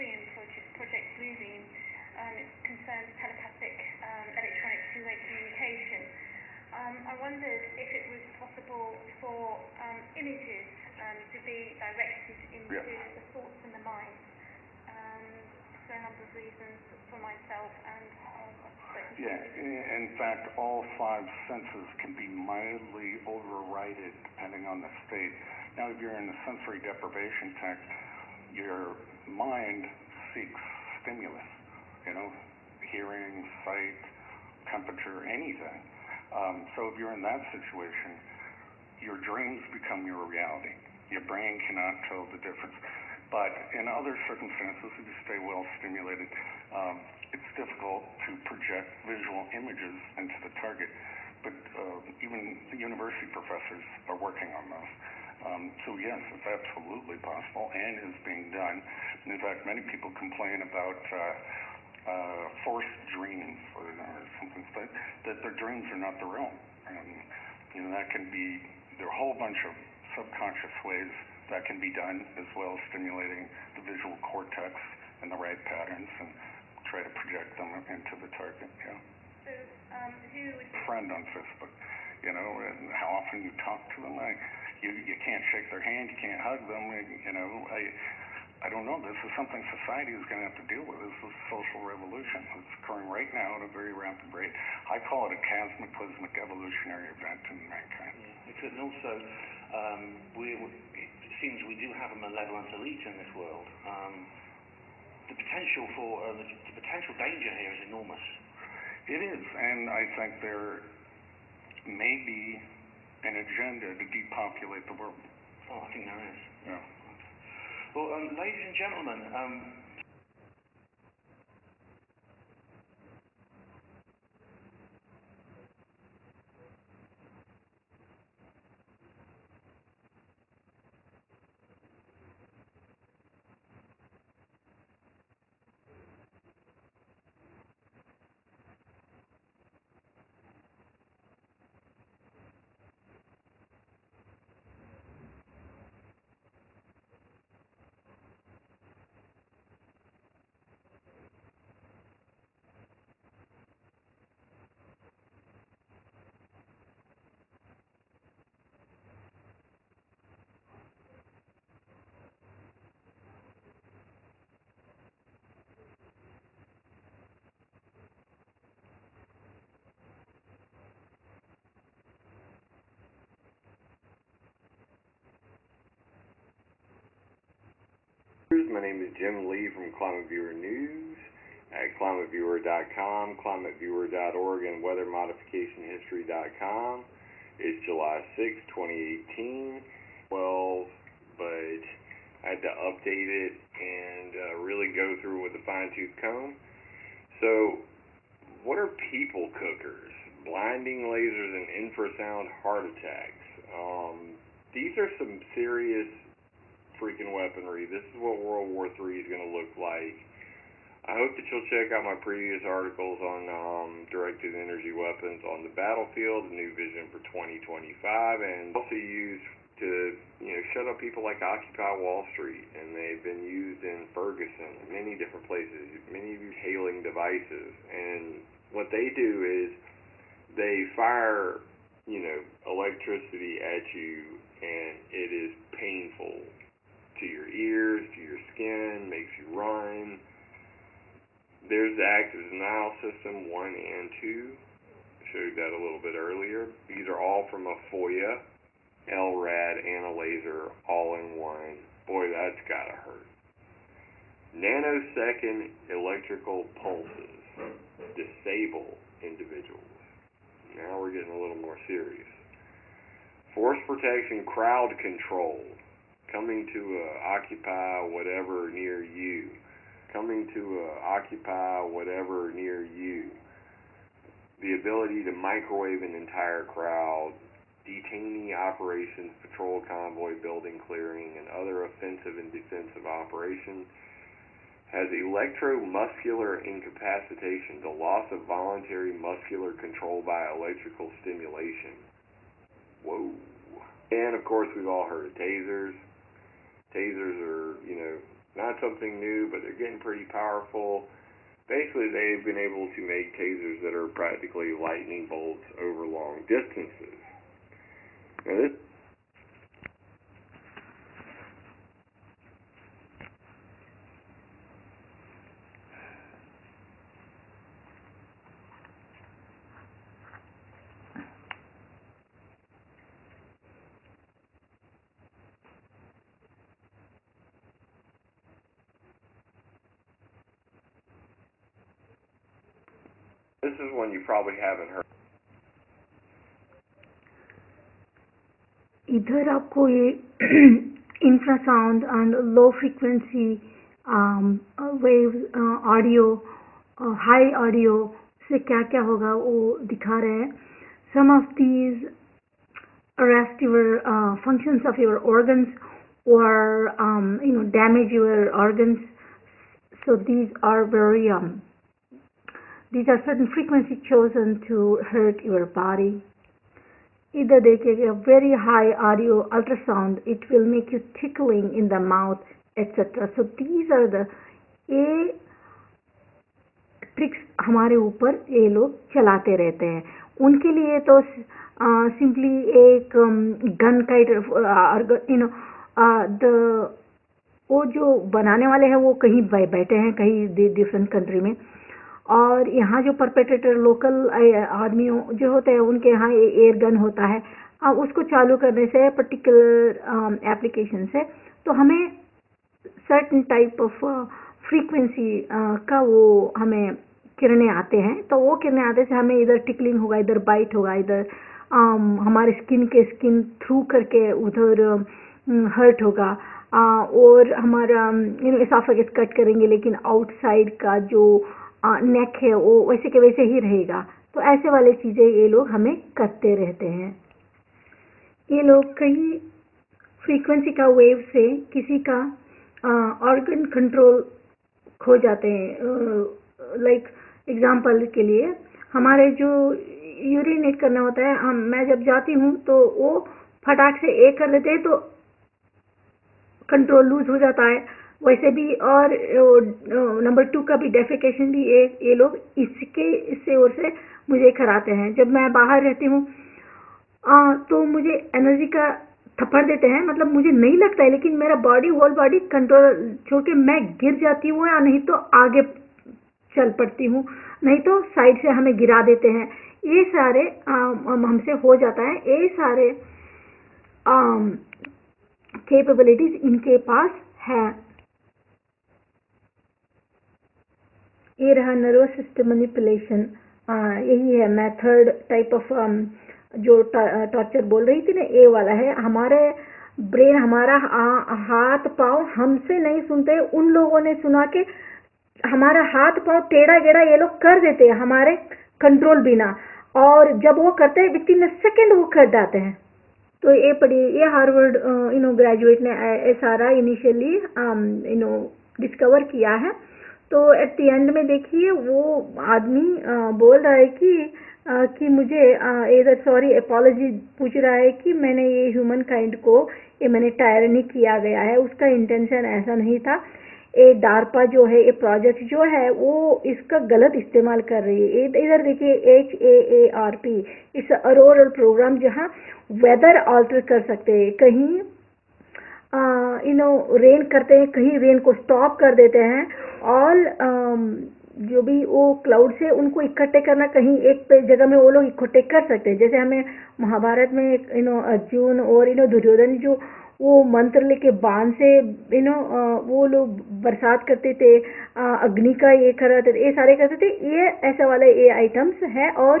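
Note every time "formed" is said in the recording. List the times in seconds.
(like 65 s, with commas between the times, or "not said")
not said.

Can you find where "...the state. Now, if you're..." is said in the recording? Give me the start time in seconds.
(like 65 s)
24 s.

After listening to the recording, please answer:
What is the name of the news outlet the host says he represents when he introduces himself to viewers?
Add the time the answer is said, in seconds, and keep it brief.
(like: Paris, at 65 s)
Climate Viewer News, at 179 s.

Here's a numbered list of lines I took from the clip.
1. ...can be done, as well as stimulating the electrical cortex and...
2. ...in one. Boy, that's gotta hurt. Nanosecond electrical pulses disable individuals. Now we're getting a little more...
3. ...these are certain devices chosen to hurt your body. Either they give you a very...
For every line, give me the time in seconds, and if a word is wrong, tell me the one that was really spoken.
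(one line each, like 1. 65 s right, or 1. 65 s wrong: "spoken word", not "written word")
1. 71 s wrong: "visual", not "electrical"
2. 251 s right
3. 362 s wrong: "frequencies", not "devices".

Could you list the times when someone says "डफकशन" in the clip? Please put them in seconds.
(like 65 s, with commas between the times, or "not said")
450 s.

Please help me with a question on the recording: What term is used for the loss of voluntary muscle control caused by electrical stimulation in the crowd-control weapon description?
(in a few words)
electromuscular incapacitation.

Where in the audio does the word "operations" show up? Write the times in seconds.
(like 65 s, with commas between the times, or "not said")
278 s, 283 s.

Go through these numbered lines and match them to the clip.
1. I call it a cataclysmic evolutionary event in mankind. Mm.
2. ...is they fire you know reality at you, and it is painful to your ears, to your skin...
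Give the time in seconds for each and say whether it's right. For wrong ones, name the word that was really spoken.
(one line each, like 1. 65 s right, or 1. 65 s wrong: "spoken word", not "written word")
1. 94 s right
2. 229 s wrong: "electricity", not "reality".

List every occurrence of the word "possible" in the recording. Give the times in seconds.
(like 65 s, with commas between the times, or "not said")
8 s, 57 s.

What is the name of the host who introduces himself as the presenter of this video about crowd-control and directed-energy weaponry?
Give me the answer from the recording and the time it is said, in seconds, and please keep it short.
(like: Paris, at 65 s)
Jim Lee, at 179 s.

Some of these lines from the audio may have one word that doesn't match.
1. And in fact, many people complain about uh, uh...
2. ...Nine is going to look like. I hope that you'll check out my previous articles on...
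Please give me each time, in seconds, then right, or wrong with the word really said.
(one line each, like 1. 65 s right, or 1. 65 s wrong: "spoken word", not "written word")
1. 59 s right
2. 208 s wrong: "Three", not "Nine".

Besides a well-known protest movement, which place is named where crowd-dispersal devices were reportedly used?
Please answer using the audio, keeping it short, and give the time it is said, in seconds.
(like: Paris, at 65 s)
Ferguson, at 224 s.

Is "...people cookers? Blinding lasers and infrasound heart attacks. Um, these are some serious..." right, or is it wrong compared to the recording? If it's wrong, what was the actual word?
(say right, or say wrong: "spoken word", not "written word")
right.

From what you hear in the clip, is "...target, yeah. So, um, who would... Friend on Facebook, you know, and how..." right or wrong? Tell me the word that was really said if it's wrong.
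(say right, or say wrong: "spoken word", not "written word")
right.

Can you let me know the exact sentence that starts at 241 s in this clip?
There's the active denial system 1 and 2.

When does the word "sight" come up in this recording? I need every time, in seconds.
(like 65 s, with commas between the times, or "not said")
33 s.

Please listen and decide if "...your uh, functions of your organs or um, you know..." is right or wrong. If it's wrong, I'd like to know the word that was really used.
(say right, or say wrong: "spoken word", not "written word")
right.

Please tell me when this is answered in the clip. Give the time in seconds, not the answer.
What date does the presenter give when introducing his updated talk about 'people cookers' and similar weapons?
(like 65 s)
187 s.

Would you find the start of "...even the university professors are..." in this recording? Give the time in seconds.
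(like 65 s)
52 s.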